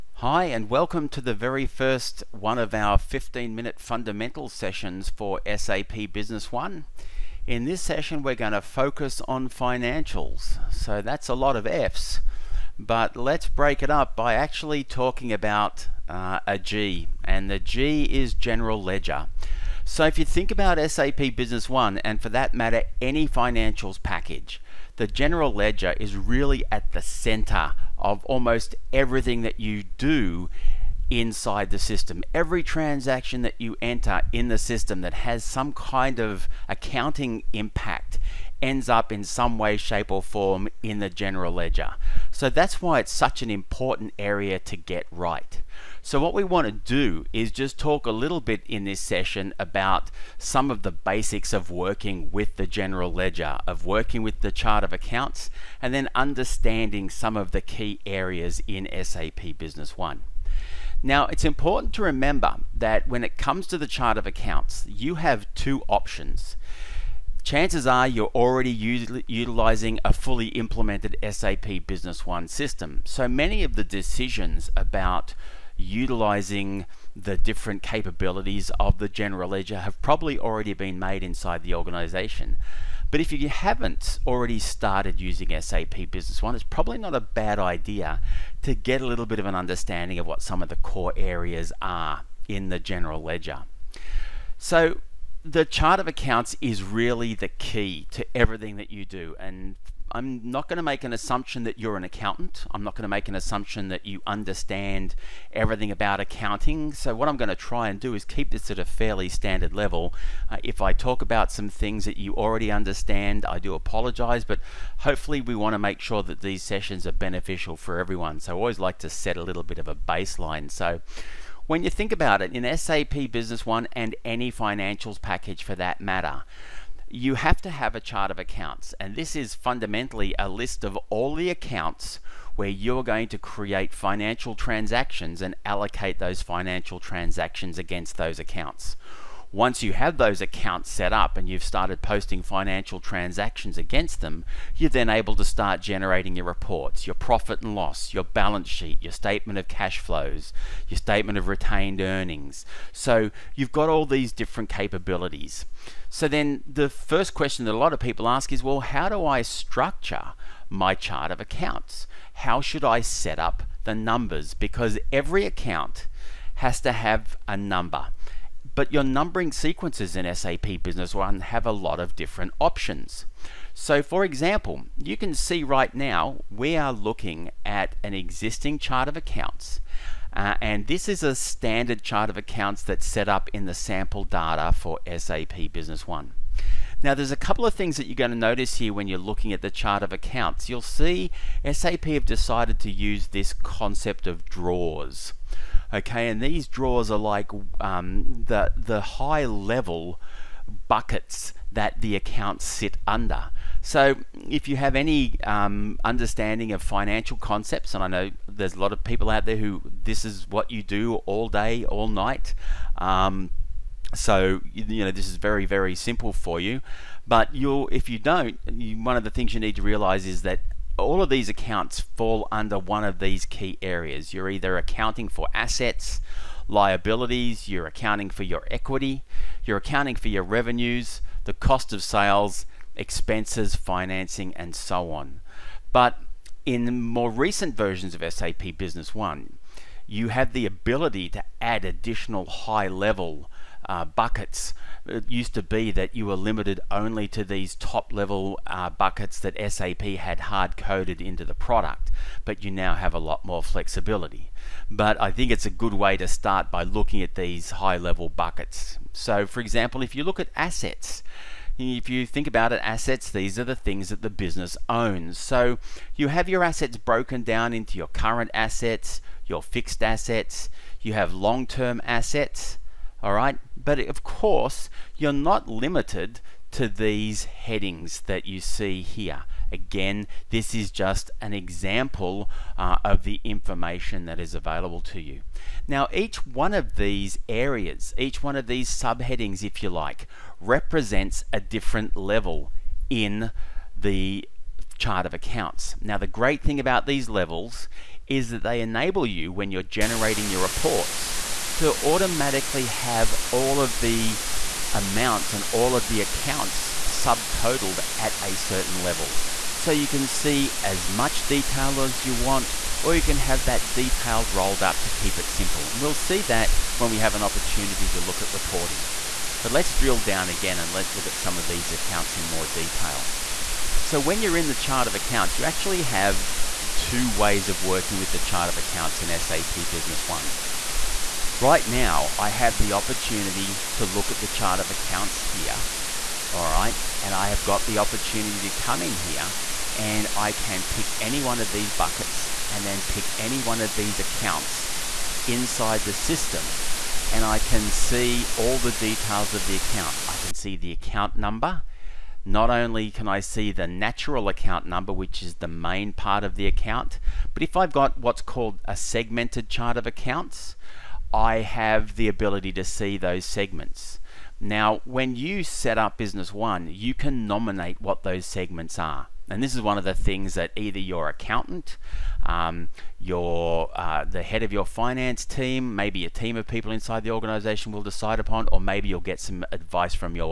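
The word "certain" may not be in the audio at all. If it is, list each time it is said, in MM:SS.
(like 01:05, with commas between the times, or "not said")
05:08.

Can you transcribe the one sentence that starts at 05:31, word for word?
Right now, I have the opportunity to look at the chart of accounts here, all right?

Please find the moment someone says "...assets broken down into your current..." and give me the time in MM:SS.
04:26.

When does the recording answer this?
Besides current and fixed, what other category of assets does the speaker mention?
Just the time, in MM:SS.
04:31.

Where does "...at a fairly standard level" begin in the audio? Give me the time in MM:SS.
01:48.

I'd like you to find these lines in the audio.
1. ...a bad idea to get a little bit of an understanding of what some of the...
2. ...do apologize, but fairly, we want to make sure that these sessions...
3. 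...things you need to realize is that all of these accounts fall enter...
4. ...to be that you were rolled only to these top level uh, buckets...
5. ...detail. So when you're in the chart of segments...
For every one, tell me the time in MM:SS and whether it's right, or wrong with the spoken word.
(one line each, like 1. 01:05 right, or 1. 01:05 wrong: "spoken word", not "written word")
1. 01:27 right
2. 01:53 wrong: "hopefully", not "fairly"
3. 03:39 wrong: "under", not "enter"
4. 04:05 wrong: "limited", not "rolled"
5. 05:22 wrong: "accounts", not "segments".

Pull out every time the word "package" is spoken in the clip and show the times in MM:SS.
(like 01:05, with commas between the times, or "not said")
00:24, 02:05.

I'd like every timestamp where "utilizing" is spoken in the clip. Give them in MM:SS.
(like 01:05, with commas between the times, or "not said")
01:09, 01:15.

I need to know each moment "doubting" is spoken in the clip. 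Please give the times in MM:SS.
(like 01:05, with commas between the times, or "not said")
not said.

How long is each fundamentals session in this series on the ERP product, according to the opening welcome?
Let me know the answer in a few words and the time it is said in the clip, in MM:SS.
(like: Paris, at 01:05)
15 minutes, at 00:02.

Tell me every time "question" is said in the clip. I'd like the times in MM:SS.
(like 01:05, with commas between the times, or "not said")
02:37.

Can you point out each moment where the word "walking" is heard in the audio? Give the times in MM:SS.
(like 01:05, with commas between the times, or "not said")
not said.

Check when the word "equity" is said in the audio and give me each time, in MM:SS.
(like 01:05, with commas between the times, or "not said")
03:48.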